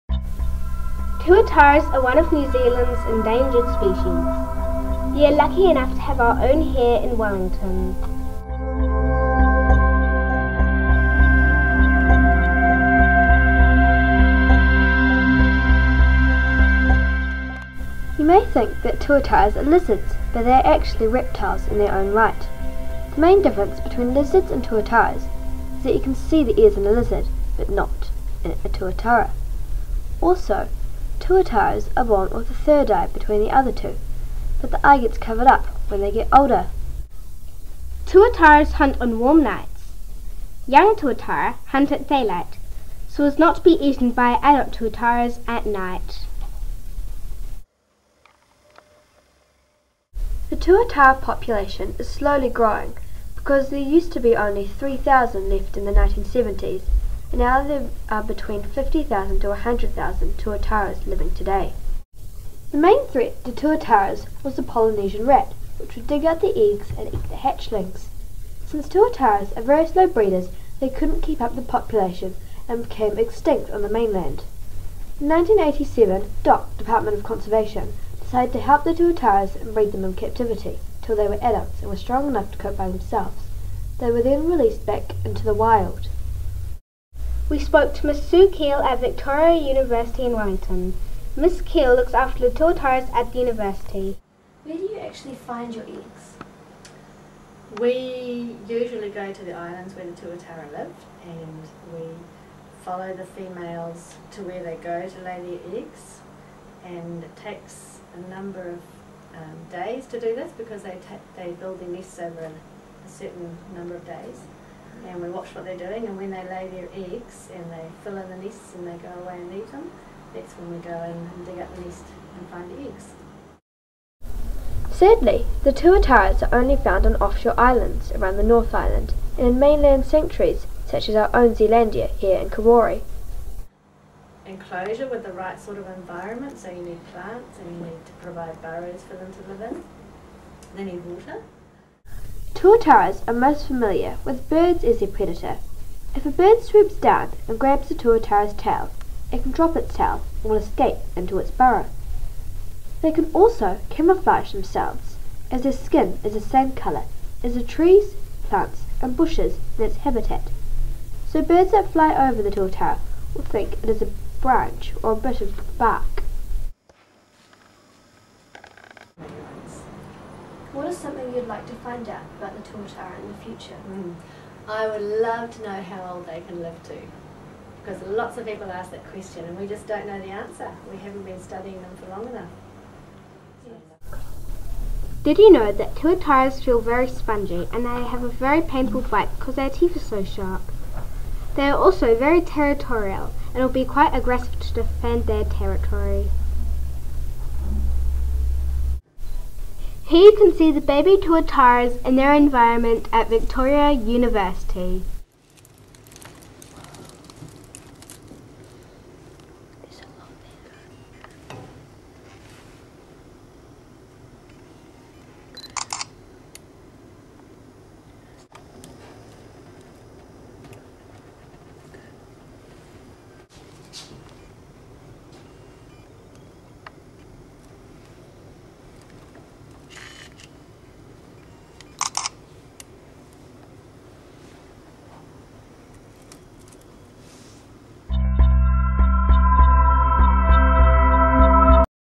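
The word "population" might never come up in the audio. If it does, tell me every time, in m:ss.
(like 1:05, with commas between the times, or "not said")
0:51, 1:11.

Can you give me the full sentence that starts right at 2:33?
They can also camouflage themselves, as their skin is the same colour as the trees, plants and bushes in its habitat.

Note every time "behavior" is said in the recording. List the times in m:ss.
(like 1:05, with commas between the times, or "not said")
not said.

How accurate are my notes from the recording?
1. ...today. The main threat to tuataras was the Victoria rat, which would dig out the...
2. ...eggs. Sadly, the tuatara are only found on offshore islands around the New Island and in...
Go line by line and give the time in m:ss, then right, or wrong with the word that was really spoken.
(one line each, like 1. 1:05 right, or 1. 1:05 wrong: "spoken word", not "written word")
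1. 1:01 wrong: "Polynesian", not "Victoria"
2. 2:02 wrong: "North", not "New".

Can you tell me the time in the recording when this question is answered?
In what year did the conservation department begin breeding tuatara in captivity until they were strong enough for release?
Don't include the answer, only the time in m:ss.
1:15.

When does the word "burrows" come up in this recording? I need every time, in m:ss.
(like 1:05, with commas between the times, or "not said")
2:18, 2:31.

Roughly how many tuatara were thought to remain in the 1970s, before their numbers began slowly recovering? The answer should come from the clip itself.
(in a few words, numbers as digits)
3,000.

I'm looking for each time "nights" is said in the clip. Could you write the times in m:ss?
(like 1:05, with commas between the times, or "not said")
0:39, 0:45.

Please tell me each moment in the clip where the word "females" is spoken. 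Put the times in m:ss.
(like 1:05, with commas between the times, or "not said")
1:43.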